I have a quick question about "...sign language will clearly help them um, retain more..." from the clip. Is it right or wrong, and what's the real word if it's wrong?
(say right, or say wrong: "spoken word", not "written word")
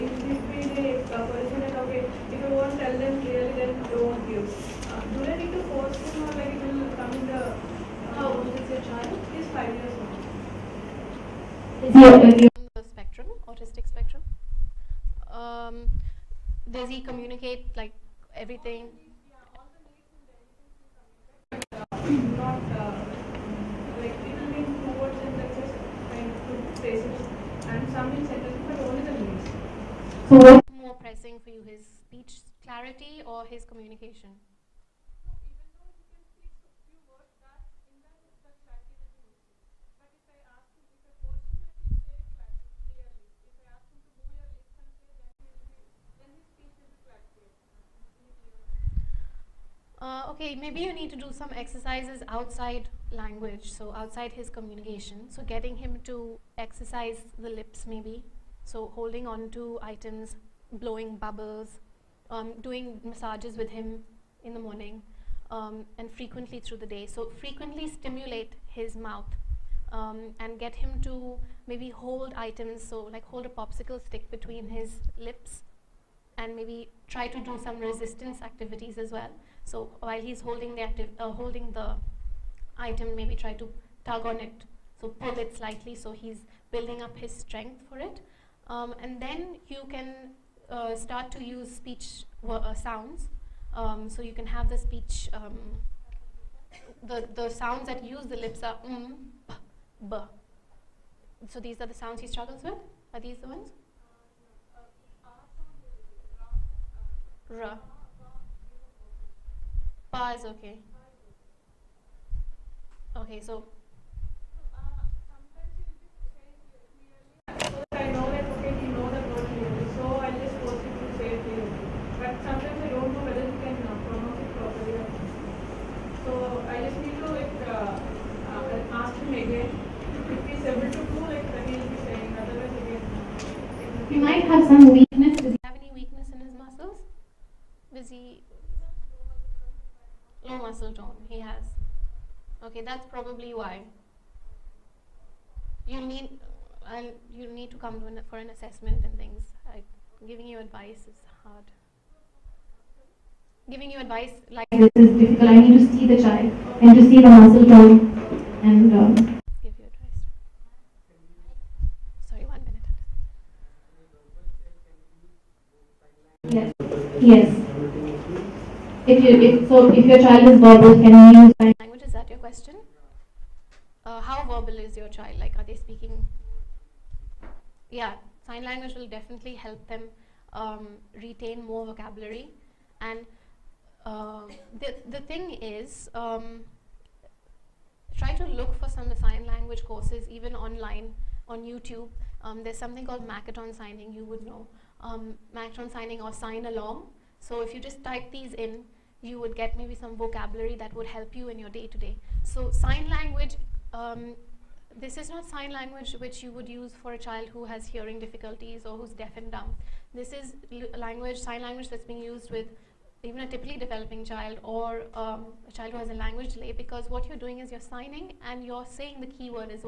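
wrong: "definitely", not "clearly".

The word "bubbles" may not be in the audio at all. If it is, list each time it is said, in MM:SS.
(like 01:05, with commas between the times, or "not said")
01:01.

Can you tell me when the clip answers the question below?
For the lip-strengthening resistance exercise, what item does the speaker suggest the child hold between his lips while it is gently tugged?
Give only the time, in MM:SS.
01:13.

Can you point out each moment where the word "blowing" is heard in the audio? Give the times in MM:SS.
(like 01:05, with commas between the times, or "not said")
01:00.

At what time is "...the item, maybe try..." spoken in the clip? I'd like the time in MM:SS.
01:21.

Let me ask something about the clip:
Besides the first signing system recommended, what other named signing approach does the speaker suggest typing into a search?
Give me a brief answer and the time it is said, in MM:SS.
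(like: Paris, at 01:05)
Signalong, at 03:16.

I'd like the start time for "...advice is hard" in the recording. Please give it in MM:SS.
02:30.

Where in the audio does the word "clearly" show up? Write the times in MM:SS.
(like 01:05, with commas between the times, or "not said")
00:03.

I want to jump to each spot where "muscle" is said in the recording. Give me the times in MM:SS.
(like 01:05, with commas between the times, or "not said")
02:20, 02:37.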